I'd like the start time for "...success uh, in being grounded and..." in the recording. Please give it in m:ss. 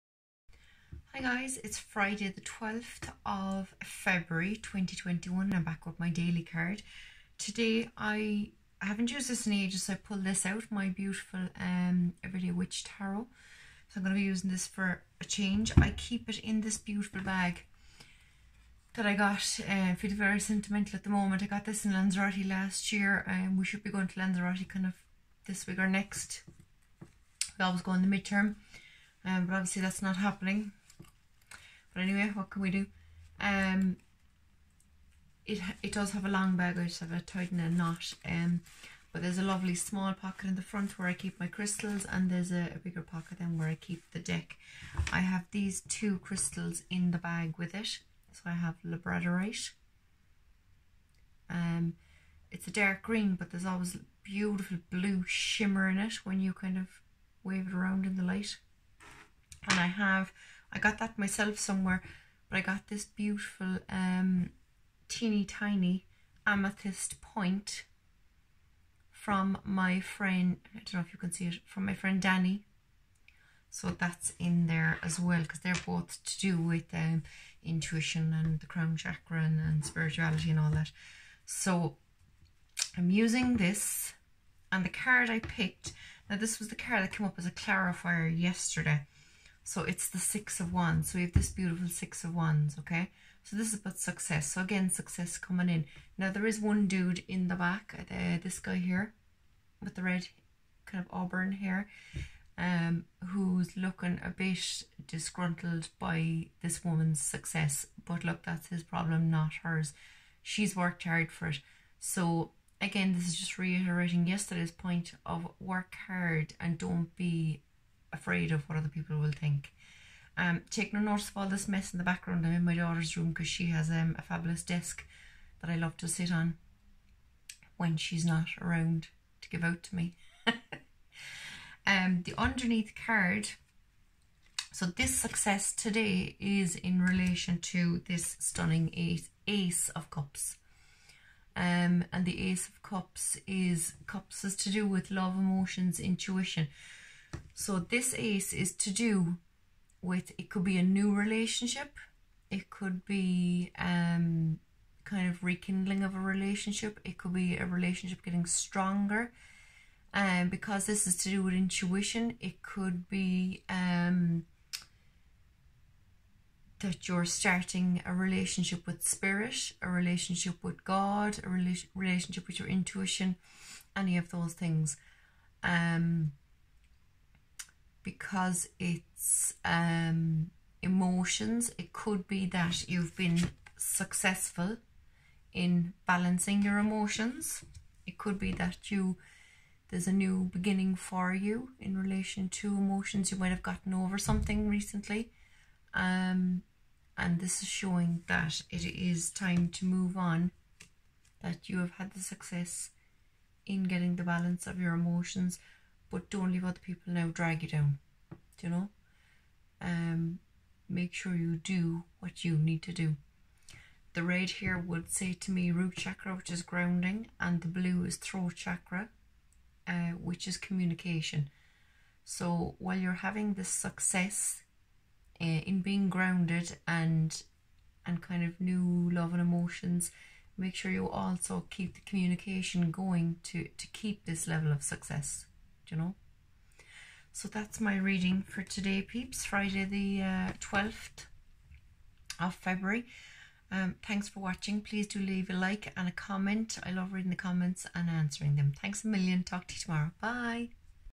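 3:43.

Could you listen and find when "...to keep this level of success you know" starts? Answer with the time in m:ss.
3:53.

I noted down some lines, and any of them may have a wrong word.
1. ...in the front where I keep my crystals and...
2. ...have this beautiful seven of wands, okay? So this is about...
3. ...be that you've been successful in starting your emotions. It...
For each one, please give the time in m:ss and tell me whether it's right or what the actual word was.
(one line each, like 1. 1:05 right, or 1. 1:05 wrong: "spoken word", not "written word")
1. 0:40 right
2. 1:31 wrong: "six", not "seven"
3. 3:02 wrong: "balancing", not "starting".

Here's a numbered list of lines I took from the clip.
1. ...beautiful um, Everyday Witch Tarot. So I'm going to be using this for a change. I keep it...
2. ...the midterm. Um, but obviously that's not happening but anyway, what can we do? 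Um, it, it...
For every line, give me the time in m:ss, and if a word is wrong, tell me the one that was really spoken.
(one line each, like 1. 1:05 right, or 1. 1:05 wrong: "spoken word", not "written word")
1. 0:10 right
2. 0:28 right.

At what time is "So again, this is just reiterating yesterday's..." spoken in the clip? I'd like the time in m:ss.
1:51.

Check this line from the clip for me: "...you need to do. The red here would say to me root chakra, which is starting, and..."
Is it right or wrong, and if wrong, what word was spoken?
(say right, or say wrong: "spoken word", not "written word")
wrong: "grounding", not "starting".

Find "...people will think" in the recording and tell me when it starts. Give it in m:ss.
1:58.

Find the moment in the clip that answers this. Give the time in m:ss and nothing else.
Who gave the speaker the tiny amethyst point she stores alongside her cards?
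1:11.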